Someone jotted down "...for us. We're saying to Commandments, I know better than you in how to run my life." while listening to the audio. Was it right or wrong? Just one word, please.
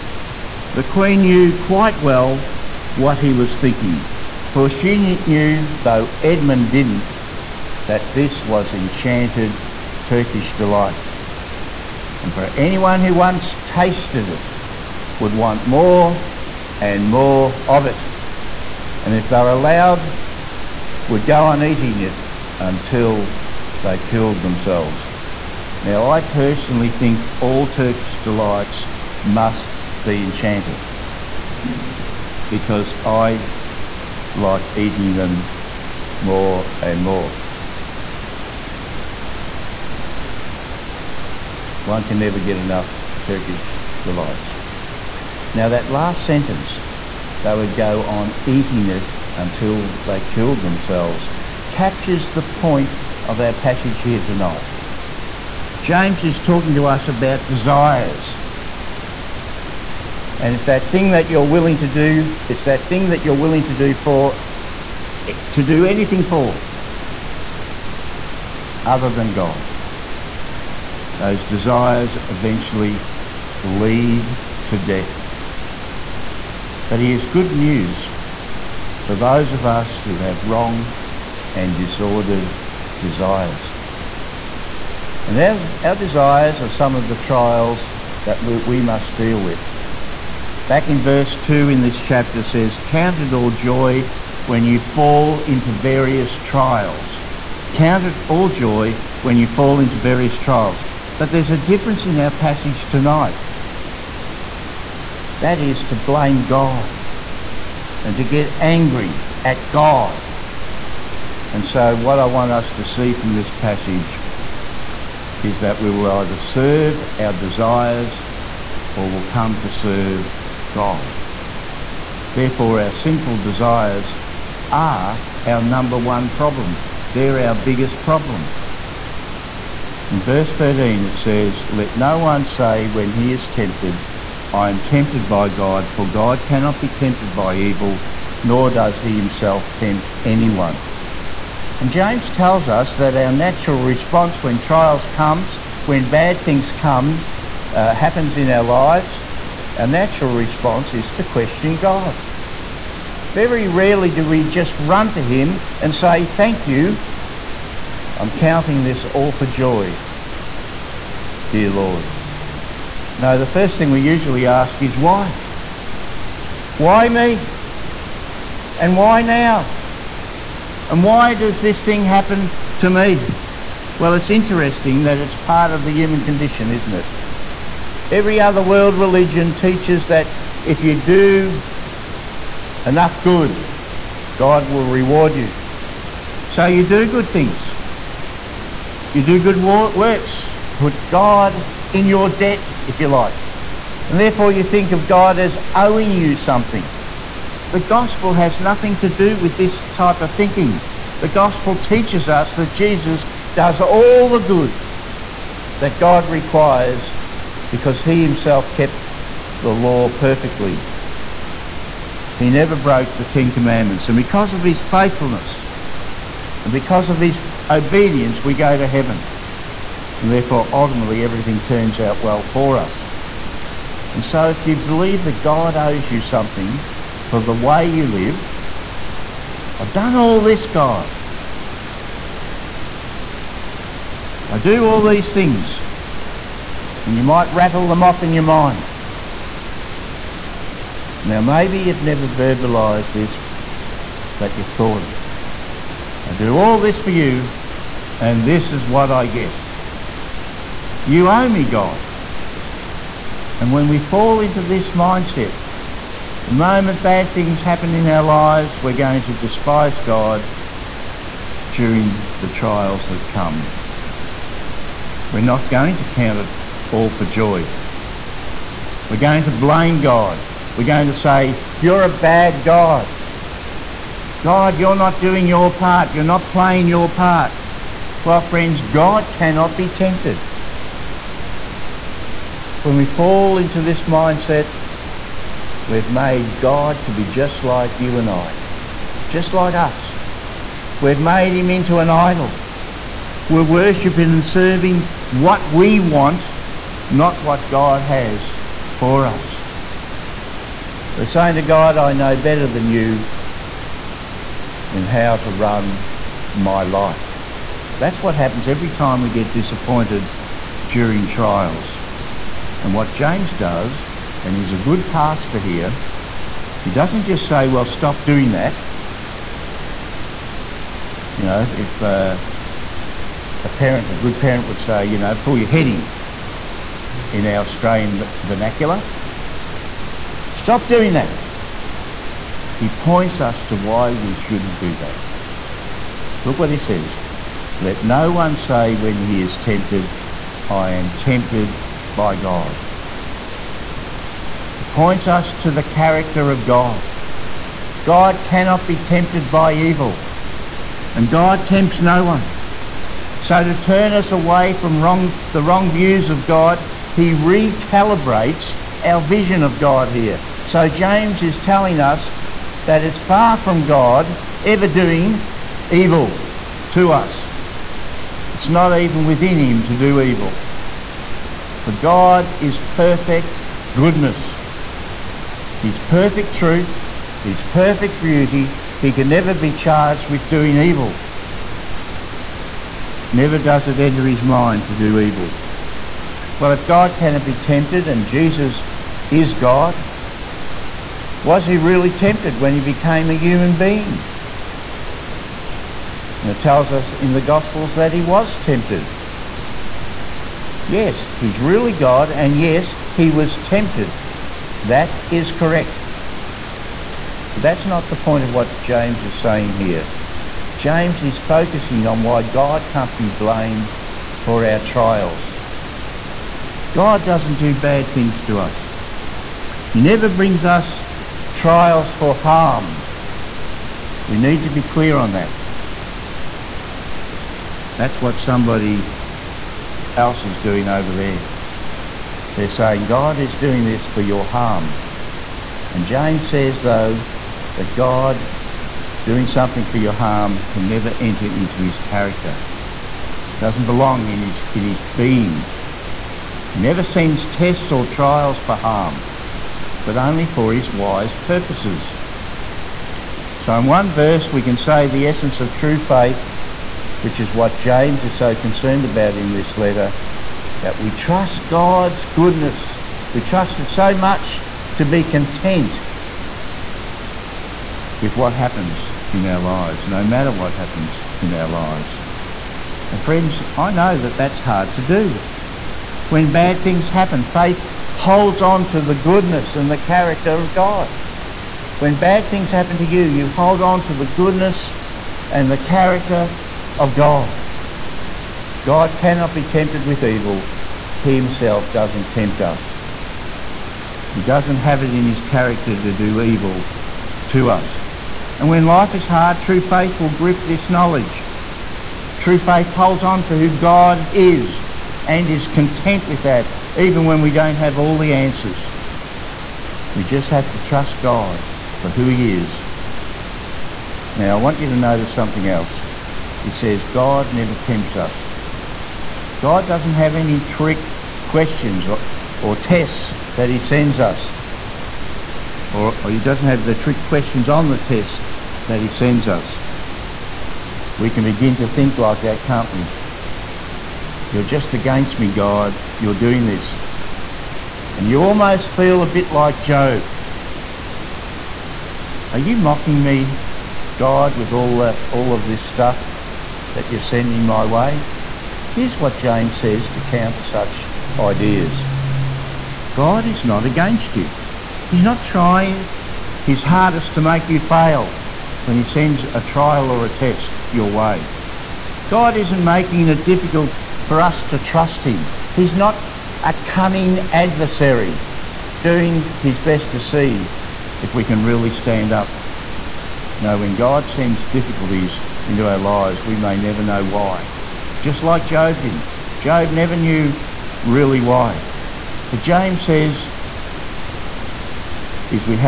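wrong.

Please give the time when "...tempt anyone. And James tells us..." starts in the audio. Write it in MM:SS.
02:19.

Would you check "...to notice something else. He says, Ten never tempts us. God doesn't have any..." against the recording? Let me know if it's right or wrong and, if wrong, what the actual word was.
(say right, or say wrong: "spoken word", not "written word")
wrong: "God", not "Ten".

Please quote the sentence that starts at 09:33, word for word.
No, when God sends difficulties into our lives, we may never know why.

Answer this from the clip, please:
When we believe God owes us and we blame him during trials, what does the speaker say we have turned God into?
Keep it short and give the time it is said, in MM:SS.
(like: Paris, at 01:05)
An idol, at 04:51.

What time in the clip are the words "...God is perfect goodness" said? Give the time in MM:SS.
06:11.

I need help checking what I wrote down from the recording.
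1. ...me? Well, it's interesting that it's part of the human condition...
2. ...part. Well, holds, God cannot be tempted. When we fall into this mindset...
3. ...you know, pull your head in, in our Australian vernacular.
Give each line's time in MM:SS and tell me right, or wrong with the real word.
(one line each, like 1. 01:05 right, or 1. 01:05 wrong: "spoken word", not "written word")
1. 02:52 right
2. 04:37 wrong: "friends", not "holds"
3. 05:25 right.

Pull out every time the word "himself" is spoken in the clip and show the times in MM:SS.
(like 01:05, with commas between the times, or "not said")
02:19, 03:28, 08:11.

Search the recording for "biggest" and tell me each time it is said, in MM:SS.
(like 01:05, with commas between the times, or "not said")
02:07.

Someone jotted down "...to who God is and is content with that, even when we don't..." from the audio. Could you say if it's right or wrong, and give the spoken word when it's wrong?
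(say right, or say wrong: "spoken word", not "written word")
right.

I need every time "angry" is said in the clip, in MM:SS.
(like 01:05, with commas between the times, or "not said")
01:48.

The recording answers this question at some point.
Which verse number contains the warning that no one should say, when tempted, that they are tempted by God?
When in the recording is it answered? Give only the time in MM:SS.
02:10.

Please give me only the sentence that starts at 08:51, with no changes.
We can begin to think like that, can't we?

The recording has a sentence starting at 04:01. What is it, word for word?
Now, maybe you've never verbalized this, but you've thought it.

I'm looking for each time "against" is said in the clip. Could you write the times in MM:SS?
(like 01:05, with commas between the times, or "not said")
08:54, 09:13.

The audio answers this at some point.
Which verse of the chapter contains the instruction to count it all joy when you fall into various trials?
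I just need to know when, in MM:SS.
01:31.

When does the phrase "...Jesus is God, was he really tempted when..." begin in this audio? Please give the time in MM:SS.
06:28.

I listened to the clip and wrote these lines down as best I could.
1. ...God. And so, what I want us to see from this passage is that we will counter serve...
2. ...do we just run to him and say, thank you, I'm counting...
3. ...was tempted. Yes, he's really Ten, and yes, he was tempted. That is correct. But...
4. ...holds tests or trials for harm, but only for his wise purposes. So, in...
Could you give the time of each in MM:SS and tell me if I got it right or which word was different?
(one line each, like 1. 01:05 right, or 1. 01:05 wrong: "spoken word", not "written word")
1. 01:49 wrong: "either", not "counter"
2. 02:34 right
3. 06:38 wrong: "God", not "Ten"
4. 07:27 wrong: "sends", not "holds".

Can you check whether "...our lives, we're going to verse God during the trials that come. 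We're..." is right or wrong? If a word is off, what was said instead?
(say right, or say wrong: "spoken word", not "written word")
wrong: "despise", not "verse".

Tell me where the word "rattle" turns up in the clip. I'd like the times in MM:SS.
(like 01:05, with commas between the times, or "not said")
03:57.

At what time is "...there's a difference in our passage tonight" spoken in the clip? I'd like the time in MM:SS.
01:41.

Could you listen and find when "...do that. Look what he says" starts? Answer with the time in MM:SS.
05:34.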